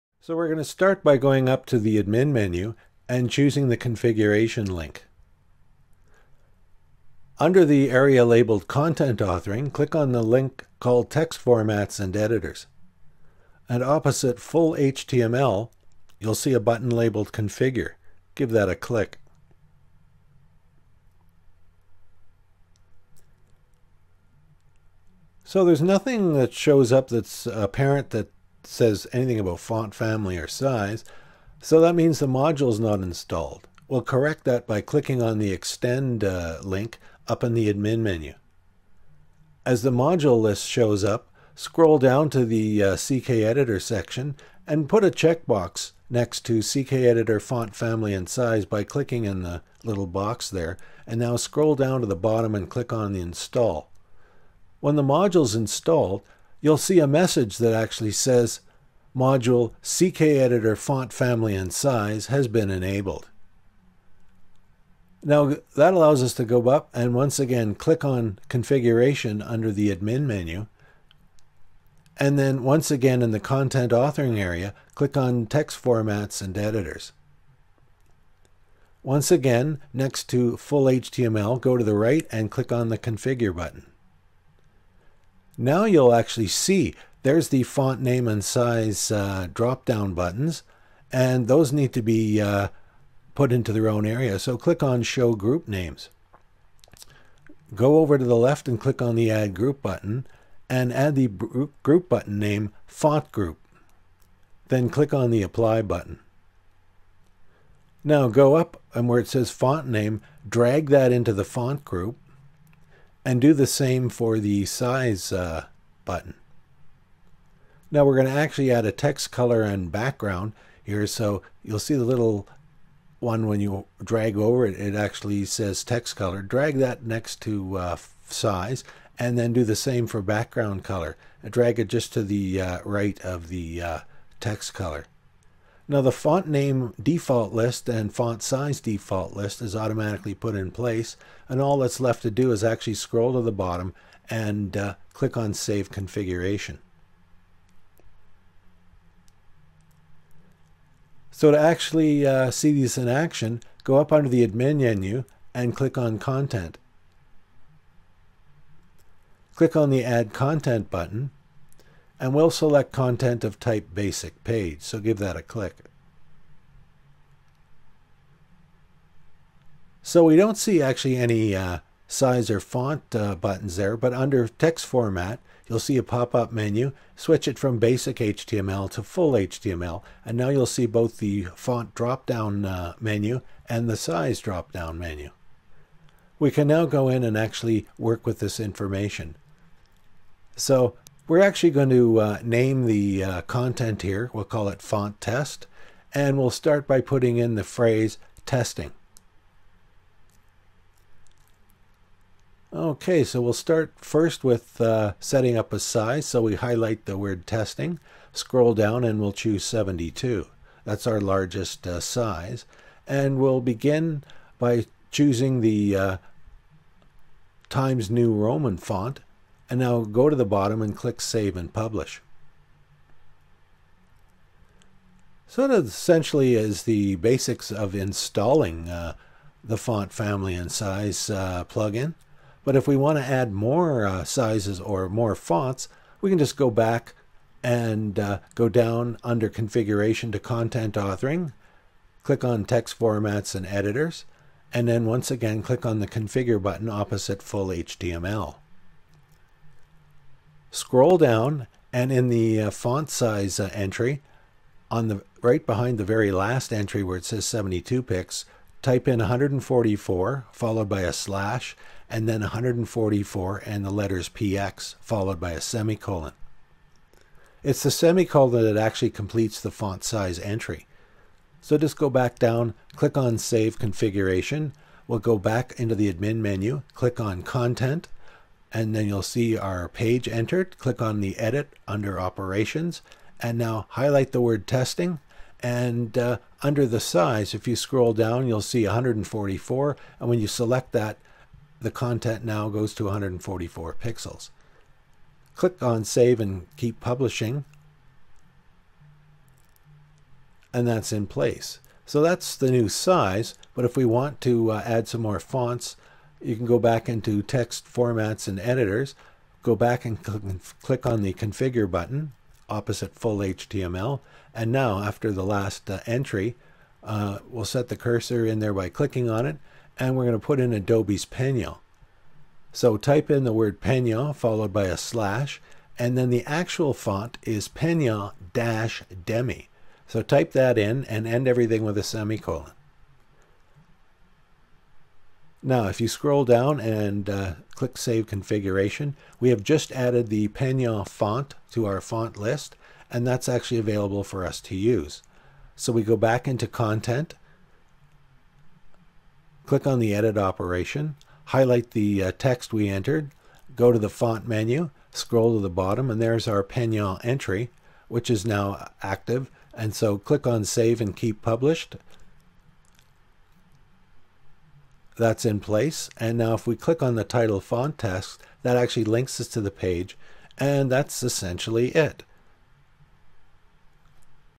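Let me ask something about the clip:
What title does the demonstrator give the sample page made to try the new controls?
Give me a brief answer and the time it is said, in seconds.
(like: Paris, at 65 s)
font test, at 194 s.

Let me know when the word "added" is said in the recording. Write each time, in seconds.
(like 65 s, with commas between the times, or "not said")
339 s.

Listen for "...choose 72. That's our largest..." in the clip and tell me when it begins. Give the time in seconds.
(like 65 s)
209 s.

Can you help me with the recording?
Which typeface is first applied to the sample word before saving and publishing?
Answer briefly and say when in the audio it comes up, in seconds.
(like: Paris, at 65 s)
Times New Roman, at 217 s.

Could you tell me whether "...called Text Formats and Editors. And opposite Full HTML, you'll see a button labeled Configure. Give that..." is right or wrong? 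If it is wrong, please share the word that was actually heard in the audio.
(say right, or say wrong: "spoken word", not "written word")
right.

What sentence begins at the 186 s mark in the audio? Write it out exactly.
We can now go in and actually work with this information.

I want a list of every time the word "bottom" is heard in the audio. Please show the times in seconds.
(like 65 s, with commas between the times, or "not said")
52 s, 143 s, 220 s, 355 s.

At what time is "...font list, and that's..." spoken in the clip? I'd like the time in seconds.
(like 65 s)
342 s.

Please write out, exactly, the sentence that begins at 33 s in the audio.
We'll correct that by clicking on the extend uh, link up in the admin menu.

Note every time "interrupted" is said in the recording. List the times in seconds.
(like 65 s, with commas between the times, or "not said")
not said.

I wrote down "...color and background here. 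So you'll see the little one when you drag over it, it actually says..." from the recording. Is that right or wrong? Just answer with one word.
right.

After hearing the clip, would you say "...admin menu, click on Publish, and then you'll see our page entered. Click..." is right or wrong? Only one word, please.
wrong.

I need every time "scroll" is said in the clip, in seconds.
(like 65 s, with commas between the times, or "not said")
41 s, 51 s, 142 s, 208 s, 250 s, 287 s, 336 s, 355 s.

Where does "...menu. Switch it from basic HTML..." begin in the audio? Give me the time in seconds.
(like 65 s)
176 s.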